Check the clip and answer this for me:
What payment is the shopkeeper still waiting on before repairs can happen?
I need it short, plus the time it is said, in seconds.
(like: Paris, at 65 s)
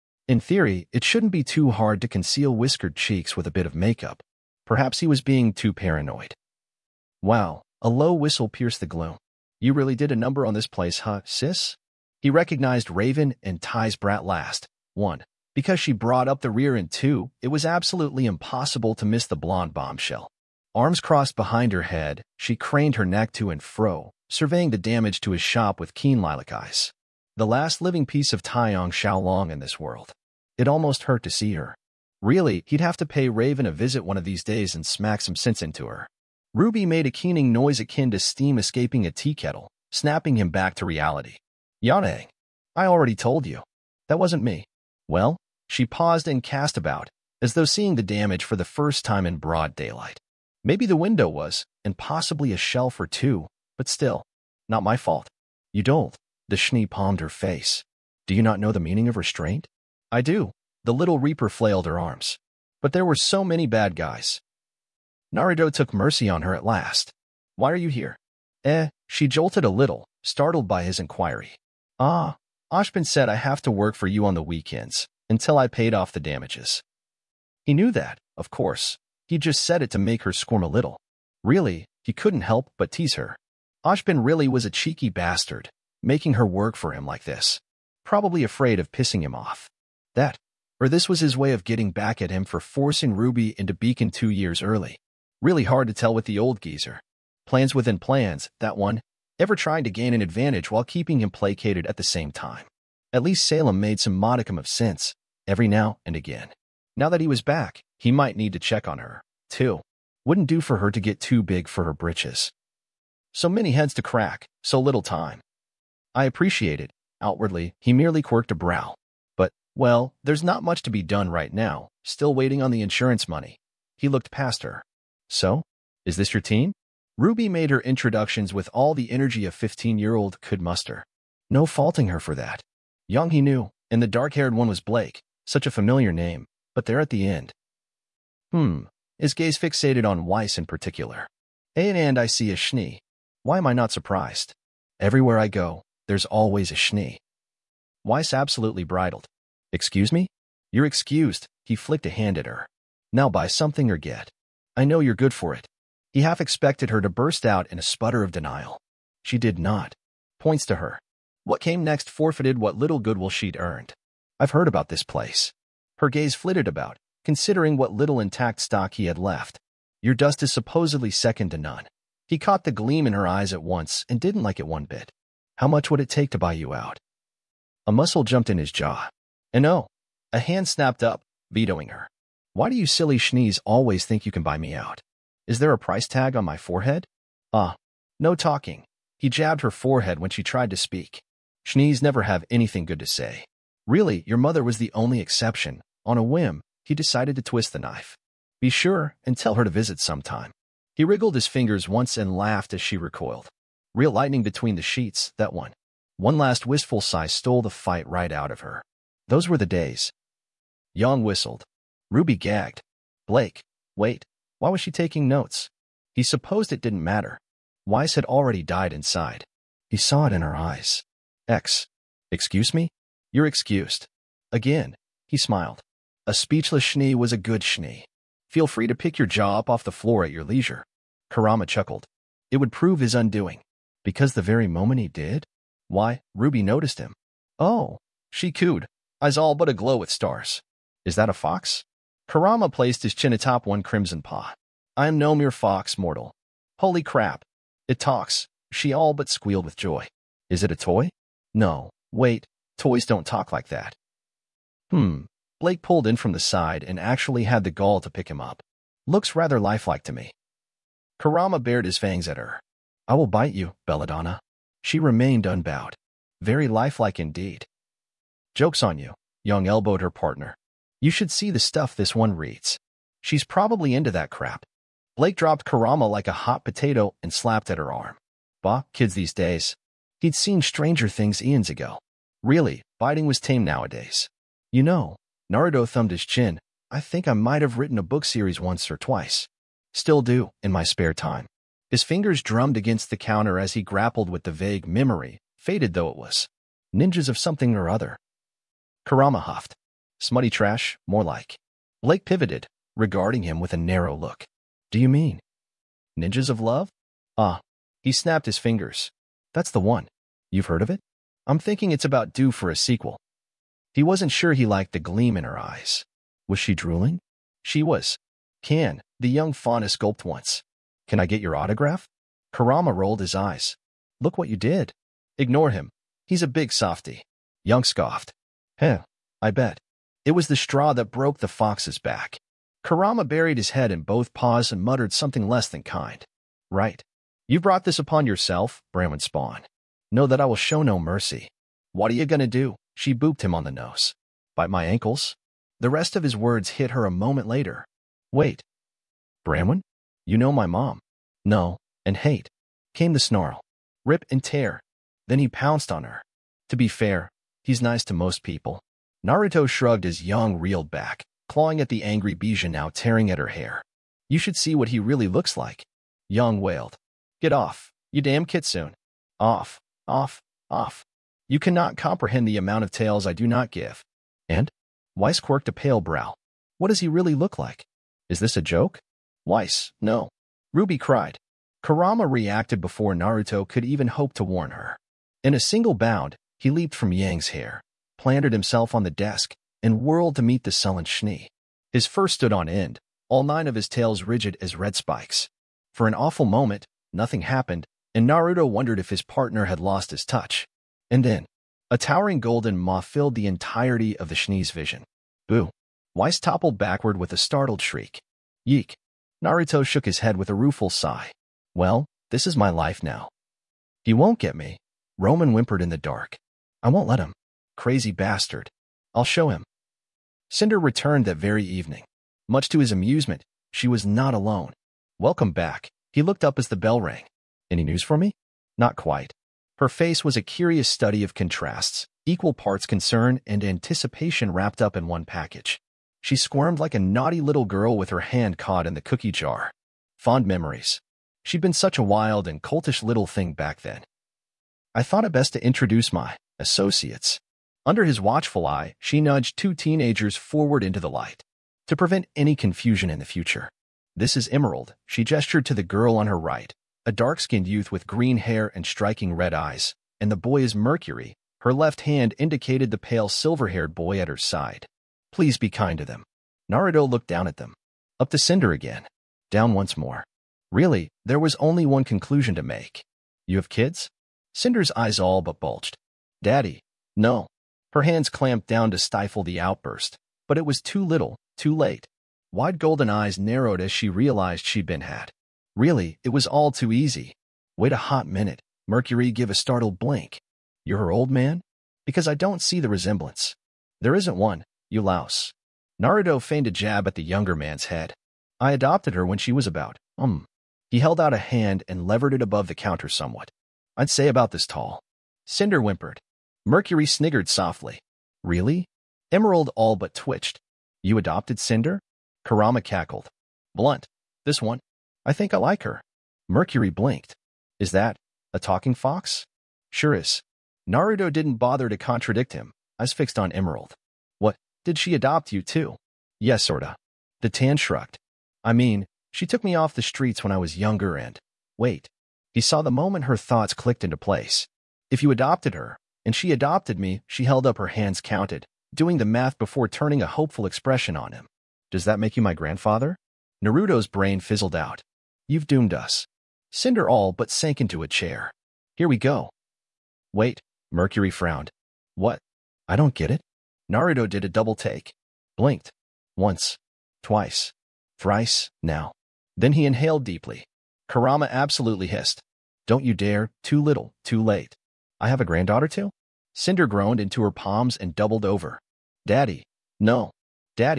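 Insurance money, at 122 s.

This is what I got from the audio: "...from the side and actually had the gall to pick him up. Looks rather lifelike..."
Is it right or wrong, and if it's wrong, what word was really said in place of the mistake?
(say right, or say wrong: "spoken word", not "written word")
right.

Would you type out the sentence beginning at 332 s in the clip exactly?
Kurama buried his head in both paws and muttered something less than kind.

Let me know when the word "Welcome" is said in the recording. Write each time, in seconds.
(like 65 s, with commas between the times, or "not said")
425 s.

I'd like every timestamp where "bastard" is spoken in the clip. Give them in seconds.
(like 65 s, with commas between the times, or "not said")
85 s, 418 s.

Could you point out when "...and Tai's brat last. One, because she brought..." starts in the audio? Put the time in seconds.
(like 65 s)
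13 s.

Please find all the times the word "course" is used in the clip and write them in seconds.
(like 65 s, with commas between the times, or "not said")
78 s.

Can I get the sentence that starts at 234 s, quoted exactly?
Because the very moment he did?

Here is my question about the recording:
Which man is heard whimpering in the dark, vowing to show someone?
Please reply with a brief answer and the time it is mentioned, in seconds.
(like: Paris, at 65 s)
Roman, at 415 s.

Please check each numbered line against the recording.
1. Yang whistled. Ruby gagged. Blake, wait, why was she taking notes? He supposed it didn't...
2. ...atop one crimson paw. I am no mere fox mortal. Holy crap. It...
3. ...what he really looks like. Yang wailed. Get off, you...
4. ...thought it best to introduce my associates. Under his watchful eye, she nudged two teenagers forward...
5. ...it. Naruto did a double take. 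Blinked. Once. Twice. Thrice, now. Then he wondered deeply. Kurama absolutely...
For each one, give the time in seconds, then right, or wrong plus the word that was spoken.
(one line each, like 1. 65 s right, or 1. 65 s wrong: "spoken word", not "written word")
1. 210 s right
2. 243 s right
3. 364 s right
4. 445 s right
5. 553 s wrong: "inhaled", not "wondered".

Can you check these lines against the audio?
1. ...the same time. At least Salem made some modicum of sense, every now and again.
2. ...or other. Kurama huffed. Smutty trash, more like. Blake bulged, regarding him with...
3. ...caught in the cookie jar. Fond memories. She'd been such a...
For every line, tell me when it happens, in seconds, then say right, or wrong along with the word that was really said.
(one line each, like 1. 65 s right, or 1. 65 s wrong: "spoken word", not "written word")
1. 101 s right
2. 297 s wrong: "pivoted", not "bulged"
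3. 438 s right.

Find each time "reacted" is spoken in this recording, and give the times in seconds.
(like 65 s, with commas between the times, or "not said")
382 s.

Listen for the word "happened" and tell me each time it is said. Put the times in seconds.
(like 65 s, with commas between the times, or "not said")
397 s.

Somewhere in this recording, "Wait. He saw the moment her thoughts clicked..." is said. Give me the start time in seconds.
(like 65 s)
531 s.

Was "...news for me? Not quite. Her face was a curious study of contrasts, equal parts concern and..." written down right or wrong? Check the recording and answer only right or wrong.
right.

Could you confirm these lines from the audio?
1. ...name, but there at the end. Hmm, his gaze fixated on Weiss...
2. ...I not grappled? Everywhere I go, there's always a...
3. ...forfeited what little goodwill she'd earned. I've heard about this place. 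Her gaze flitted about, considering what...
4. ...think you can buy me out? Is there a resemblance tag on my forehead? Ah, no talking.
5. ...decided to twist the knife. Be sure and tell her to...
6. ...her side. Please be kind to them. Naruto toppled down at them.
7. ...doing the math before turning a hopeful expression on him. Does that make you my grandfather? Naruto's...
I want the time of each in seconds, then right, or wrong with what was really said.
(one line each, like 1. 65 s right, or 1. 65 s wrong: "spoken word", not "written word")
1. 136 s right
2. 143 s wrong: "surprised", not "grappled"
3. 162 s right
4. 184 s wrong: "price", not "resemblance"
5. 196 s right
6. 464 s wrong: "looked", not "toppled"
7. 538 s right.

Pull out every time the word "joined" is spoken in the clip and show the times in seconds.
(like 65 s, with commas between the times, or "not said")
not said.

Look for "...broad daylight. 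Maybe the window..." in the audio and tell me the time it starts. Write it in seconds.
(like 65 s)
49 s.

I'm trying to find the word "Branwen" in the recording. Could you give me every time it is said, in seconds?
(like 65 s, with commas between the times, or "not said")
338 s, 349 s.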